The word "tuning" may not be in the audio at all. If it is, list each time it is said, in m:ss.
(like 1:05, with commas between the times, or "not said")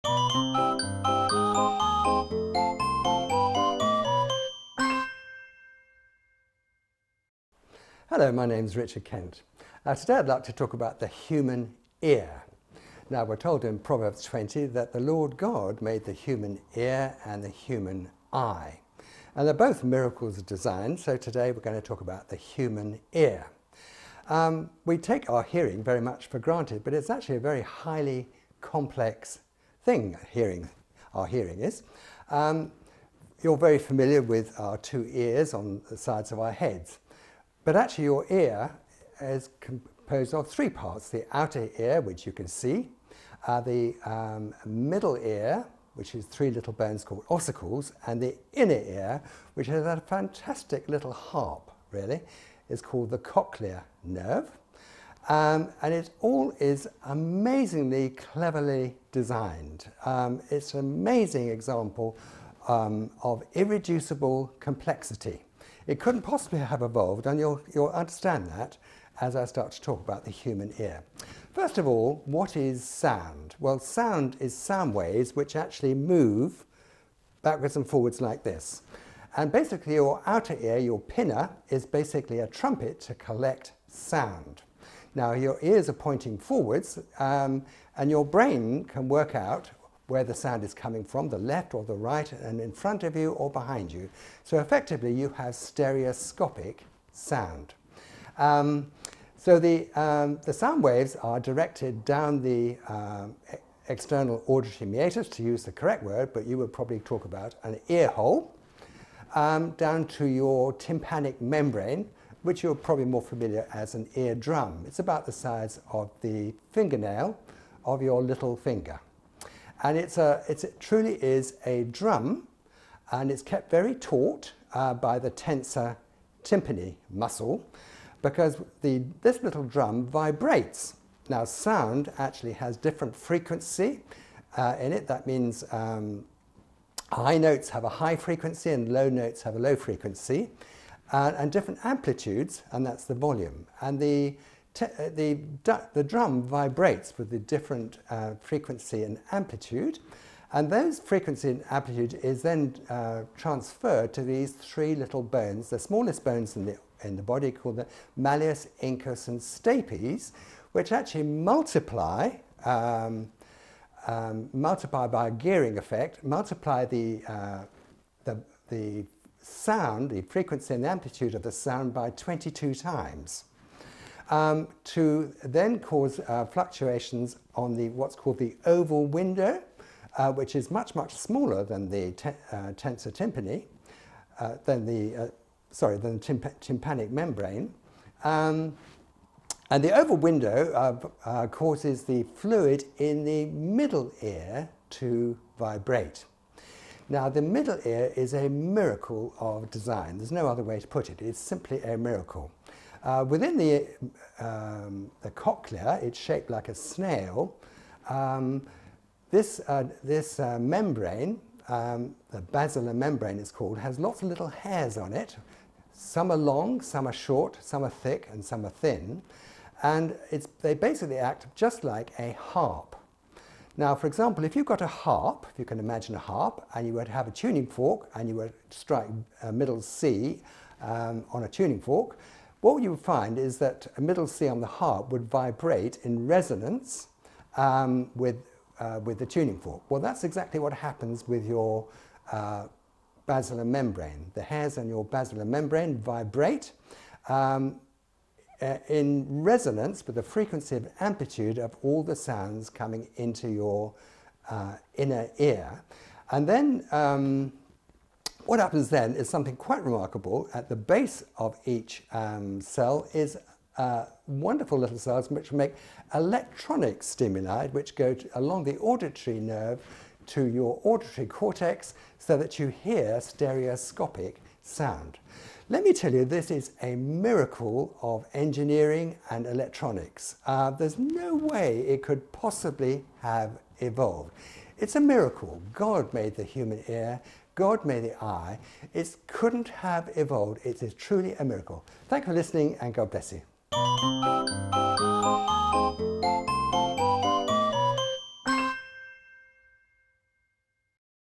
3:47, 3:51, 3:59.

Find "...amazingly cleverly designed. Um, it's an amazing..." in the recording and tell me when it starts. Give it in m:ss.
0:57.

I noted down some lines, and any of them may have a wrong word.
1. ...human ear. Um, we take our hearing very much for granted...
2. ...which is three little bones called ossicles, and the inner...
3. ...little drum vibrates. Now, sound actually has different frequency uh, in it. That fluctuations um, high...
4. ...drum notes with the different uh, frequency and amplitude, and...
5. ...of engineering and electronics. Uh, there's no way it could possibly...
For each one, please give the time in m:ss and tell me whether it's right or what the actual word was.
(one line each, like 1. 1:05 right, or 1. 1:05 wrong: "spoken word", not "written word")
1. 0:22 right
2. 0:45 right
3. 2:09 wrong: "means", not "fluctuations"
4. 2:26 wrong: "vibrates", not "notes"
5. 4:38 right.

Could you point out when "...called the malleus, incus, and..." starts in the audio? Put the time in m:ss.
2:37.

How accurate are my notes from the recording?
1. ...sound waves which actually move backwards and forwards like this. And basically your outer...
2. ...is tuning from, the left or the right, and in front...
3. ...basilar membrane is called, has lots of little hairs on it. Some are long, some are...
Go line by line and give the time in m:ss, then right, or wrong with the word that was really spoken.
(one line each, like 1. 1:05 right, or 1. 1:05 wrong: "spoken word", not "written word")
1. 1:14 right
2. 1:30 wrong: "coming", not "tuning"
3. 3:32 right.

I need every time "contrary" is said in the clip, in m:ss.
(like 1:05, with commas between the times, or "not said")
not said.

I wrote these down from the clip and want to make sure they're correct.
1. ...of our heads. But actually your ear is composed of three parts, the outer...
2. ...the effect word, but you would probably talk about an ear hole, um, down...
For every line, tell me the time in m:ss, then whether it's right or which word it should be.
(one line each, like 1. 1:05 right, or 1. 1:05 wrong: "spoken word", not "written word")
1. 0:36 right
2. 1:45 wrong: "correct", not "effect".